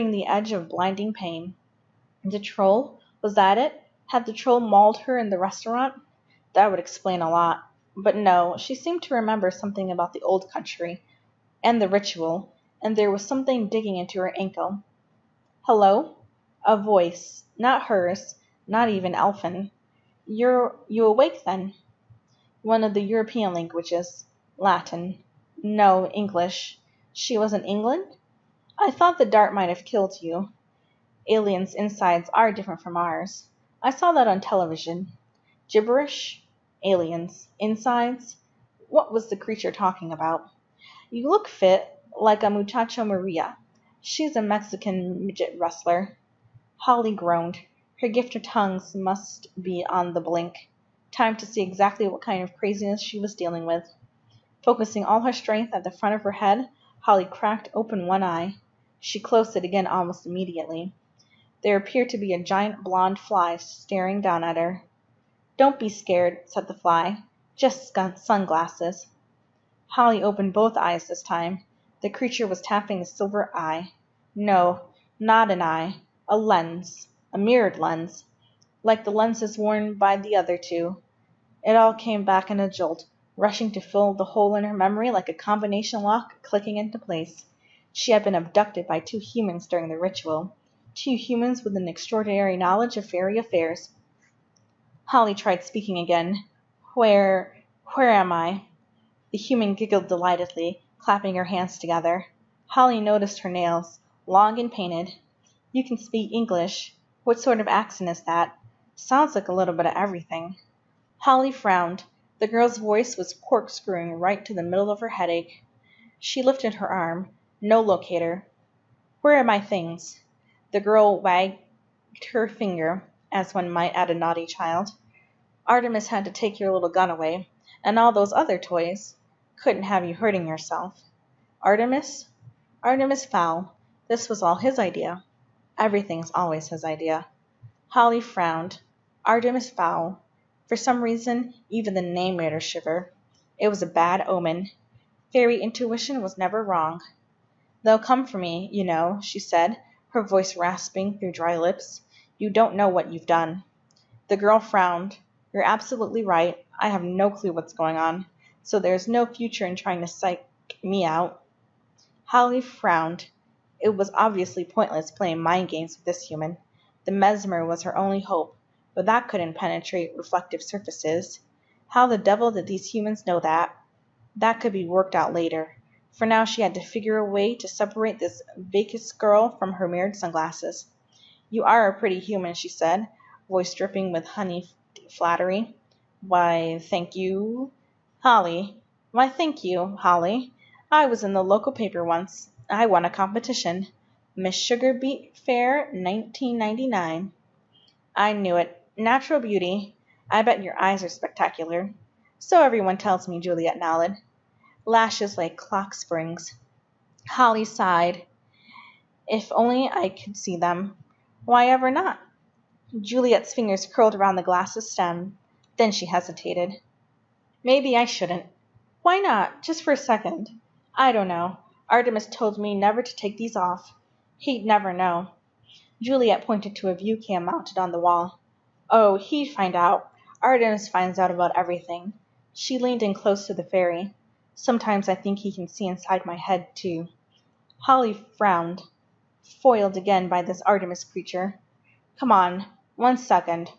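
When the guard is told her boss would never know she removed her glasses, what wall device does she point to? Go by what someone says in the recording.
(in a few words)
A view cam.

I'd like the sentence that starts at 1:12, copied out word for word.
The creature was tapping a silver eye.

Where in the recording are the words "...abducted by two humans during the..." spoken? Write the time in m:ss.
1:28.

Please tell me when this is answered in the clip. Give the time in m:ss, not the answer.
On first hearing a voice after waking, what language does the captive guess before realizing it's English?
0:24.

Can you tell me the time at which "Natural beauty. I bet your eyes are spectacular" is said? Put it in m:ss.
3:18.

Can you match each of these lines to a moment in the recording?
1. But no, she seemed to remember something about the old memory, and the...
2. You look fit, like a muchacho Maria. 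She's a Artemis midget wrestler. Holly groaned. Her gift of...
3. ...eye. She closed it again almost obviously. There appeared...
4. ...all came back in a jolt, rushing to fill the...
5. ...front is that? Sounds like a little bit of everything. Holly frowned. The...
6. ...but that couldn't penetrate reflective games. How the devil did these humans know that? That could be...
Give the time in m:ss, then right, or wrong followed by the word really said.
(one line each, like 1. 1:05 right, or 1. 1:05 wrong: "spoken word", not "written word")
1. 0:07 wrong: "country", not "memory"
2. 0:41 wrong: "Mexican", not "Artemis"
3. 0:58 wrong: "immediately", not "obviously"
4. 1:21 right
5. 1:47 wrong: "accent", not "front"
6. 2:48 wrong: "surfaces", not "games".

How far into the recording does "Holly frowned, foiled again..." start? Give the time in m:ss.
3:57.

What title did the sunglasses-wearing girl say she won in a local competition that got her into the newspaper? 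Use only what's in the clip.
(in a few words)
Miss Sugar Beet Fair 1999.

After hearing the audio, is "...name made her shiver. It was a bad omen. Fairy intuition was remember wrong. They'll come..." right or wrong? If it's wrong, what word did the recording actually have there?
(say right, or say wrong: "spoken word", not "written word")
wrong: "never", not "remember".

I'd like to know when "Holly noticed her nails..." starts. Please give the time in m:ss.
1:42.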